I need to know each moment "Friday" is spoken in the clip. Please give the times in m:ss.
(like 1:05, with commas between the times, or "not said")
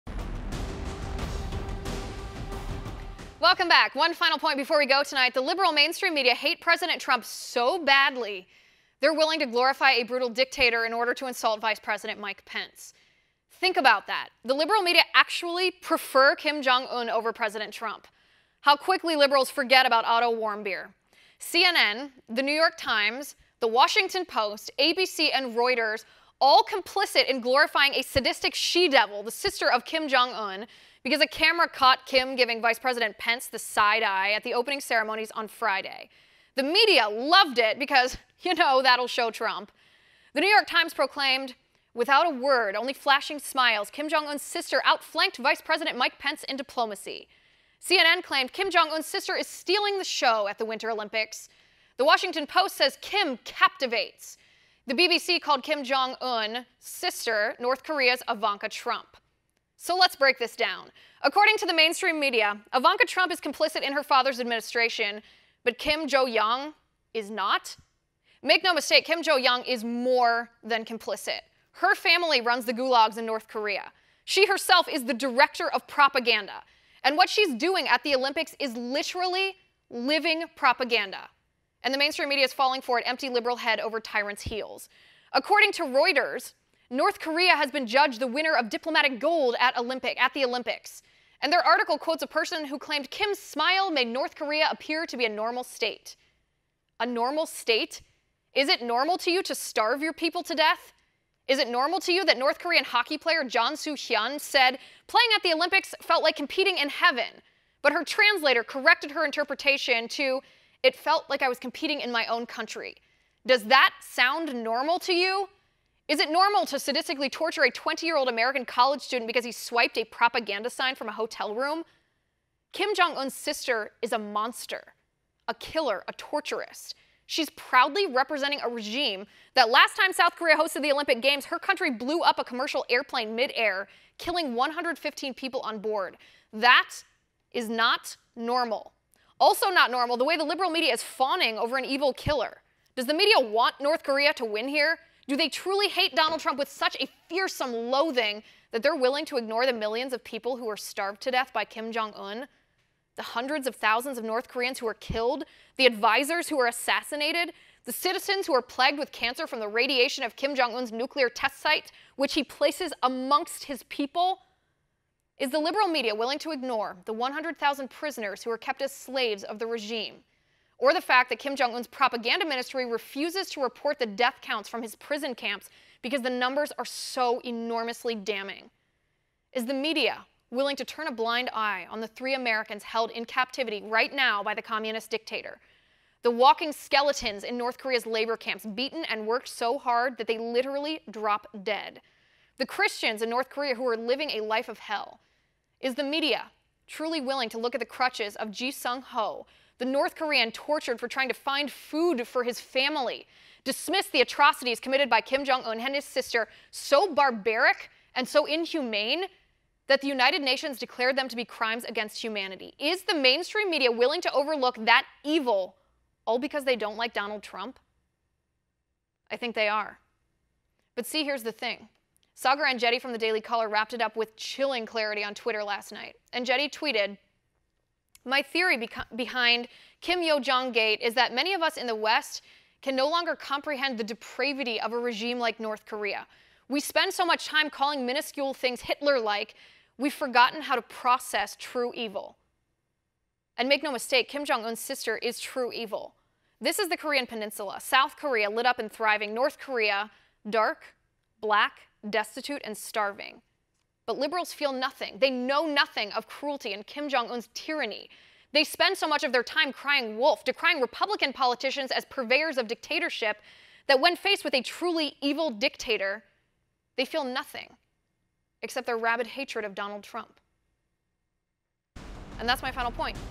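0:35.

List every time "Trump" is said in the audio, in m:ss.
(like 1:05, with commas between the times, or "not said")
0:07, 0:17, 0:39, 0:58, 1:03, 2:26, 3:37, 4:30.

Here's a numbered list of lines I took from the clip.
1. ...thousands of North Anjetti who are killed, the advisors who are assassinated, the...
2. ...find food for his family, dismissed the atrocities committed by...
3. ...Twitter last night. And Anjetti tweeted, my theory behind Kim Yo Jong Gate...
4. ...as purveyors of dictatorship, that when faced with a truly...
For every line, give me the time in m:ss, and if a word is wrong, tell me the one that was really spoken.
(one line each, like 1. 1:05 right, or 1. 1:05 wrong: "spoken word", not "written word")
1. 2:33 wrong: "Koreans", not "Anjetti"
2. 3:21 right
3. 3:45 right
4. 4:21 right.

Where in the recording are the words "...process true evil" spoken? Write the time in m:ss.
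4:00.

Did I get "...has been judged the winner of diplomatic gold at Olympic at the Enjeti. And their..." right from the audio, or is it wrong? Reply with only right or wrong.
wrong.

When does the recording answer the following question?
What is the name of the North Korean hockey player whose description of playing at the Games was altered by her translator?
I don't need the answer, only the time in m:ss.
1:43.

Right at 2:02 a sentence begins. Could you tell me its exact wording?
Kim Jong-un's sister is a monster, a killer, a torturist.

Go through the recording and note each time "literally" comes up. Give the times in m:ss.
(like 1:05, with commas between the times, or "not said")
1:18, 3:10.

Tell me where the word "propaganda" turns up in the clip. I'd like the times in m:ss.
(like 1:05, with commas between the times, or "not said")
1:15, 1:20, 2:00, 2:51.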